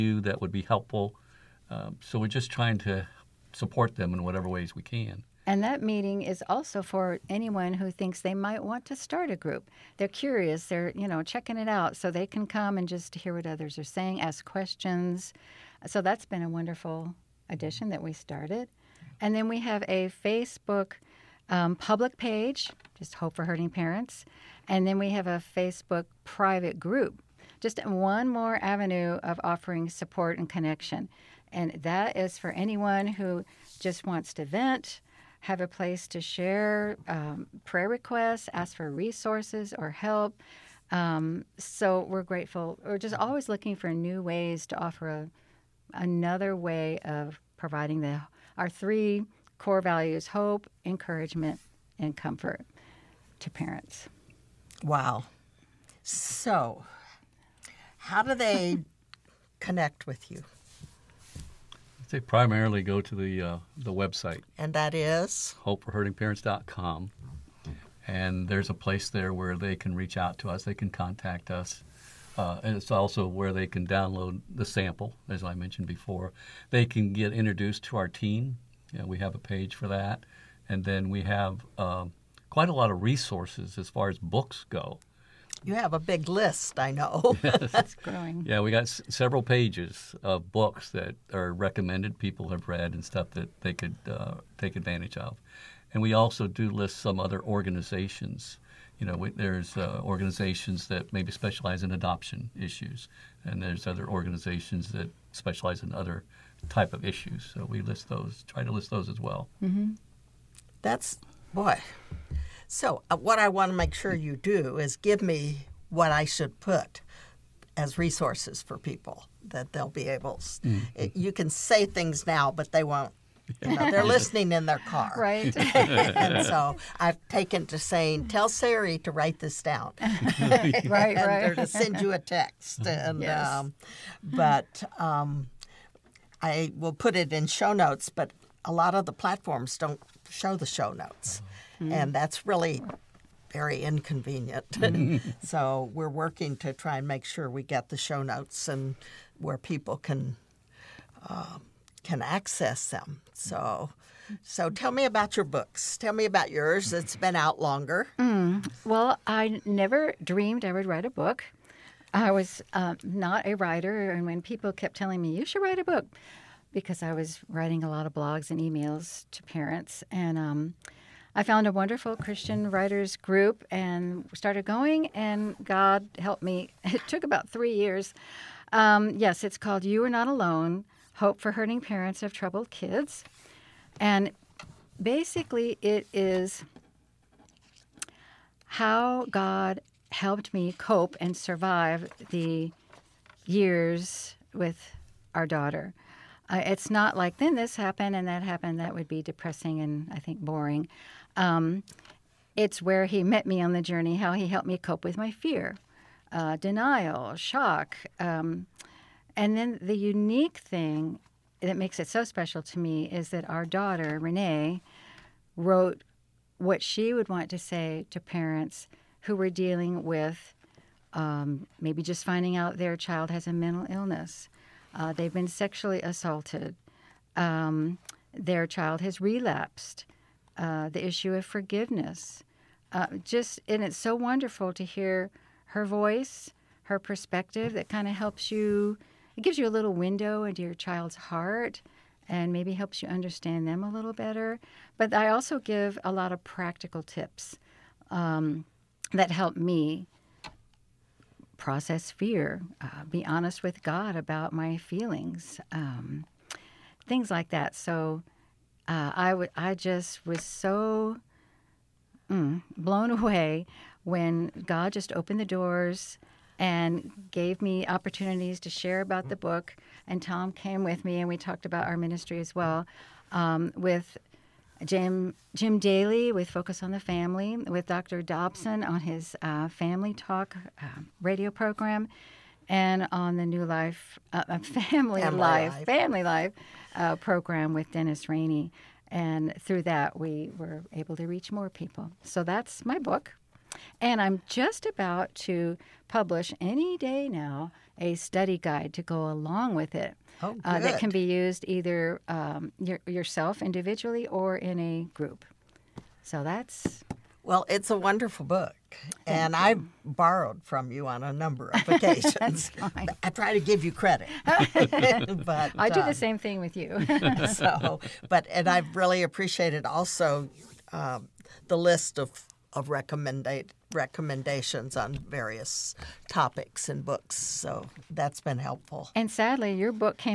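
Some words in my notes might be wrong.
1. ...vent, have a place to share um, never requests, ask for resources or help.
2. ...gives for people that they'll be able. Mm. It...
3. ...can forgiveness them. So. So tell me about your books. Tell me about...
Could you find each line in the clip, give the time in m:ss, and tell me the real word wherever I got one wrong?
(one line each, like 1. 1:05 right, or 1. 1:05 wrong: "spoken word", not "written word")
1. 0:34 wrong: "prayer", not "never"
2. 1:57 wrong: "resources", not "gives"
3. 2:32 wrong: "access", not "forgiveness".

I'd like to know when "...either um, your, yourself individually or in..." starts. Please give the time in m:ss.
5:01.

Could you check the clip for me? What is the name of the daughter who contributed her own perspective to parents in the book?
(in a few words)
Renee.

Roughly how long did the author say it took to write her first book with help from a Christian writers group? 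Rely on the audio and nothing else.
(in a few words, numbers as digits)
3 years.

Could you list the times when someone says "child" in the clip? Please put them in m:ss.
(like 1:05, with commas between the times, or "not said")
3:42, 3:48, 4:00.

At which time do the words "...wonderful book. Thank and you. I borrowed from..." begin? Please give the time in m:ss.
5:07.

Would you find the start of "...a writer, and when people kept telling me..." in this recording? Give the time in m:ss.
2:43.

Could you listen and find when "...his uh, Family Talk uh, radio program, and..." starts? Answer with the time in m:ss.
4:38.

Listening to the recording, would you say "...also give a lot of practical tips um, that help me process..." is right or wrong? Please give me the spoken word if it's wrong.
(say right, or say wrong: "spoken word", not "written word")
right.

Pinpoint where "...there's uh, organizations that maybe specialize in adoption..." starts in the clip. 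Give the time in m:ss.
1:39.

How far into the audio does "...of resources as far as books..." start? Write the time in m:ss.
1:22.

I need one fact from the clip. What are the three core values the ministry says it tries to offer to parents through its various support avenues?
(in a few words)
hope, encouragement, and comfort.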